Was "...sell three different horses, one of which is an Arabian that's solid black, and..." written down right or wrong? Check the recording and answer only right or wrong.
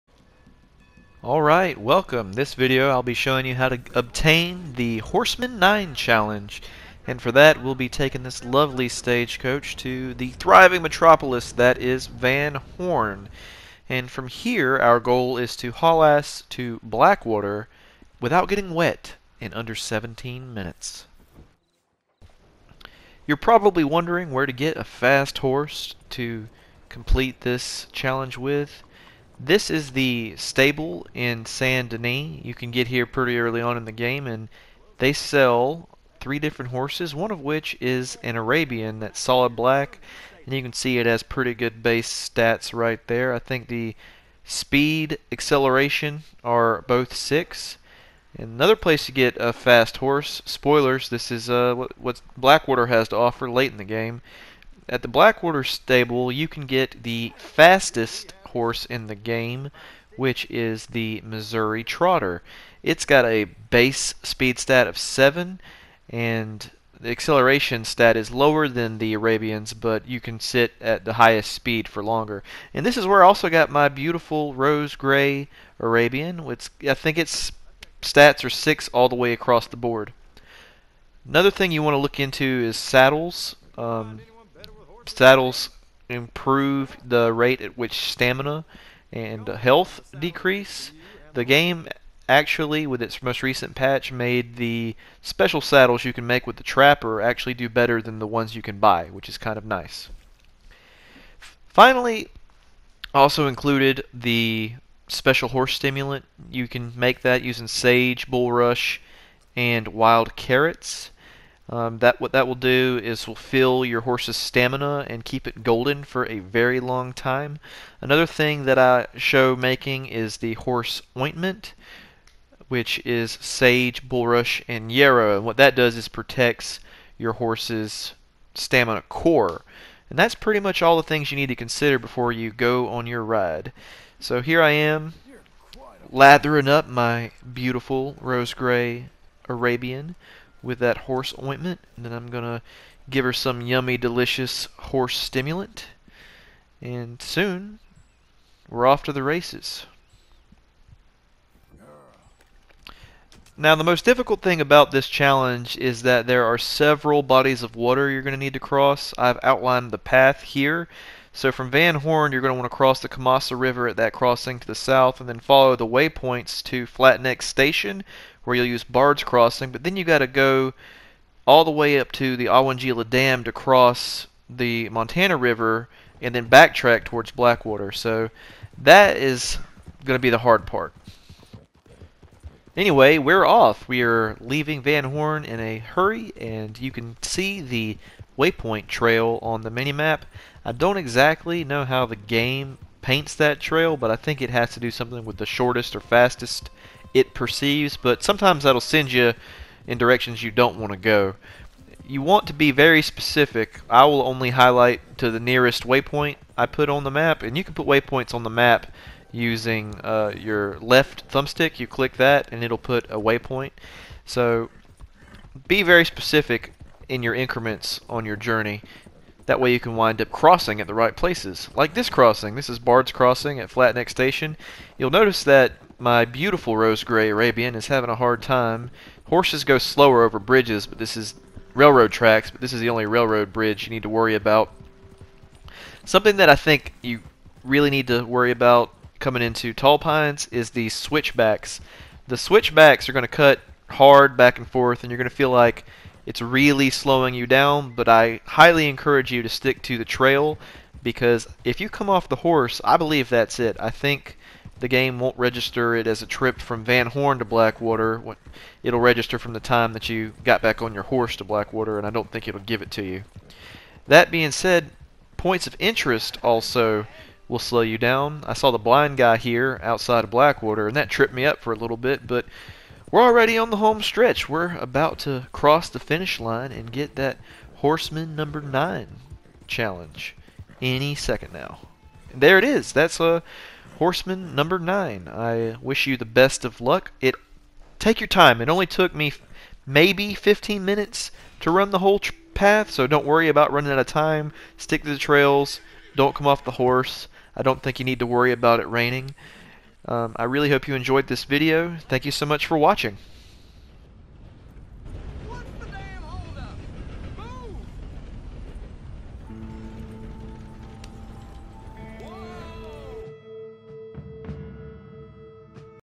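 right.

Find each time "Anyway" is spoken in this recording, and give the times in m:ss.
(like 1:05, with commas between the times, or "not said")
3:02.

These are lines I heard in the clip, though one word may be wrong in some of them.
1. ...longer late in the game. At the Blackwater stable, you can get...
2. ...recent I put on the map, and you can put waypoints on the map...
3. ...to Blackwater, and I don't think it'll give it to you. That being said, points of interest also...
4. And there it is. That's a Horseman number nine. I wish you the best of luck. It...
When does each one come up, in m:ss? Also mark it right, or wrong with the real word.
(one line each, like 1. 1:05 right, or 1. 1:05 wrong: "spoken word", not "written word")
1. 0:53 wrong: "offer", not "longer"
2. 3:25 wrong: "waypoint", not "recent"
3. 4:21 right
4. 4:42 right.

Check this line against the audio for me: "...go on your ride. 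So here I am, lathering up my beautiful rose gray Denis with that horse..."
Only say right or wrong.
wrong.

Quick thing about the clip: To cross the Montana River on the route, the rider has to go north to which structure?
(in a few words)
Owanjila Dam.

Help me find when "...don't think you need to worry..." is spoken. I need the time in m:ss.
4:57.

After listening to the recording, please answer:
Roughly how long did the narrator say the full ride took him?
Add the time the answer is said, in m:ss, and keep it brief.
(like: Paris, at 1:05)
15 minutes, at 4:50.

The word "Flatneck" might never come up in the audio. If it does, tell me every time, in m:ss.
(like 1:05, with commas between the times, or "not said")
2:46, 3:43.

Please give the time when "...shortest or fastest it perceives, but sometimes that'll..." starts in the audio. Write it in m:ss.
3:15.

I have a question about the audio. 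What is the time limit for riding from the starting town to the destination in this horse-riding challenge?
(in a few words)
17 minutes.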